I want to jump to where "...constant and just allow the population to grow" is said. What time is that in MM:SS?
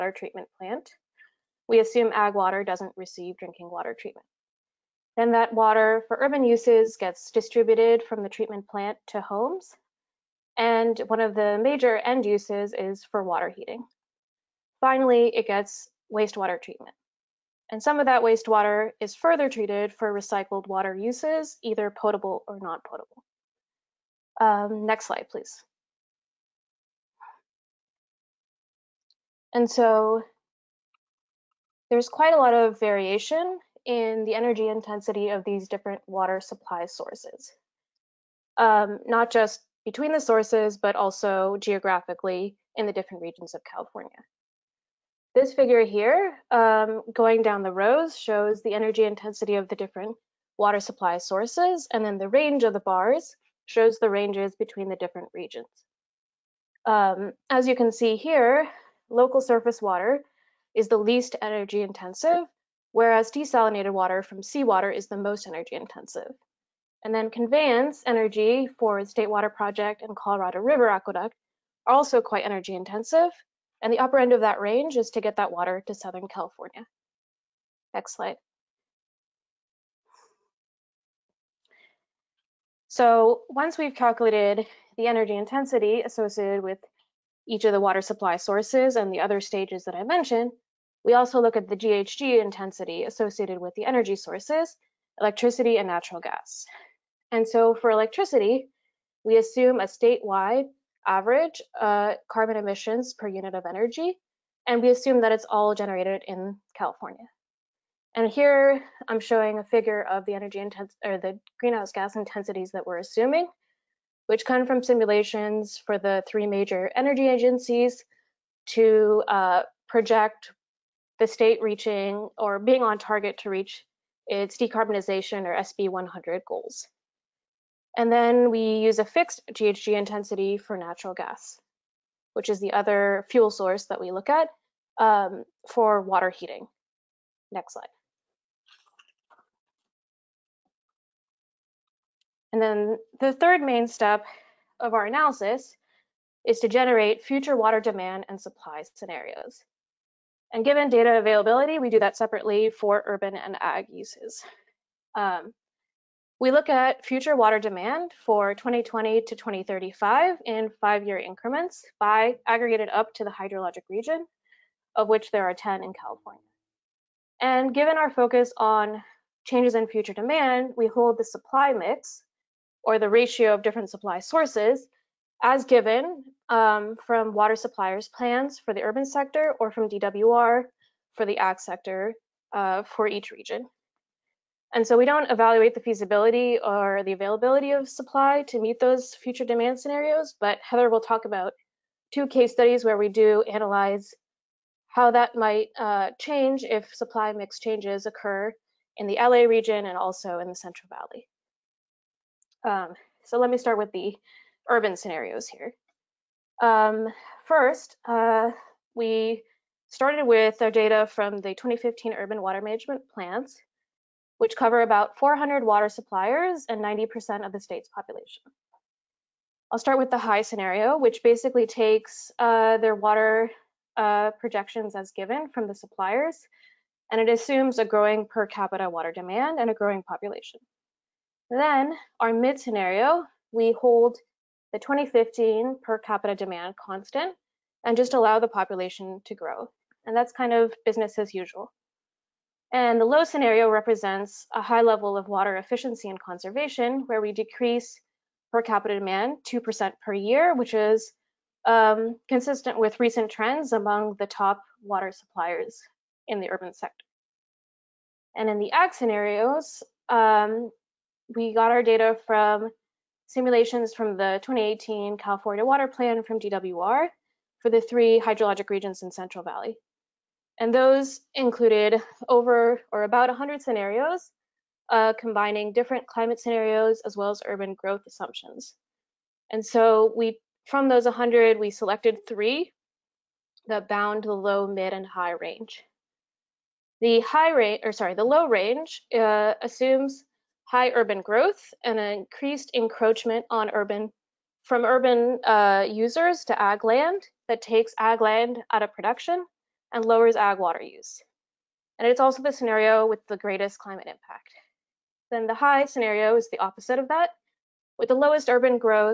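03:56.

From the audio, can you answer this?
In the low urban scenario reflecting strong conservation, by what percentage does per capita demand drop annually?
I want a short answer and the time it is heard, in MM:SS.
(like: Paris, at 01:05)
2%, at 04:09.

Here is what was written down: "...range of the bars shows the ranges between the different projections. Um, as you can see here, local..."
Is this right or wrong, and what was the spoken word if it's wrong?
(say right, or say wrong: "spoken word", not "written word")
wrong: "regions", not "projections".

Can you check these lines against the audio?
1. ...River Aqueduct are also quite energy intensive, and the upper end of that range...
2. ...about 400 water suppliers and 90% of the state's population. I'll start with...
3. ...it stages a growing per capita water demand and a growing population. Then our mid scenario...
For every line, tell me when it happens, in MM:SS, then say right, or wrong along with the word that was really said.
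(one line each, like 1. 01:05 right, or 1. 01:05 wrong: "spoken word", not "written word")
1. 01:10 right
2. 03:34 right
3. 03:47 wrong: "assumes", not "stages".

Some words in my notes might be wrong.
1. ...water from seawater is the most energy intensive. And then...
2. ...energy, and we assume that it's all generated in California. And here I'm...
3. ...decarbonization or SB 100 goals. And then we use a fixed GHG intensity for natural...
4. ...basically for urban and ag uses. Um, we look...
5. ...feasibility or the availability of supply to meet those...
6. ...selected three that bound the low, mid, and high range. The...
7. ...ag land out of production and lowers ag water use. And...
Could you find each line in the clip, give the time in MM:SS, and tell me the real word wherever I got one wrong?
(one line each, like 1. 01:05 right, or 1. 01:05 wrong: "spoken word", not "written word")
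1. 01:03 right
2. 01:43 right
3. 02:04 right
4. 02:32 wrong: "separately", not "basically"
5. 03:05 right
6. 04:41 right
7. 04:57 right.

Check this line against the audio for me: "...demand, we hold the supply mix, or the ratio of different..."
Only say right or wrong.
right.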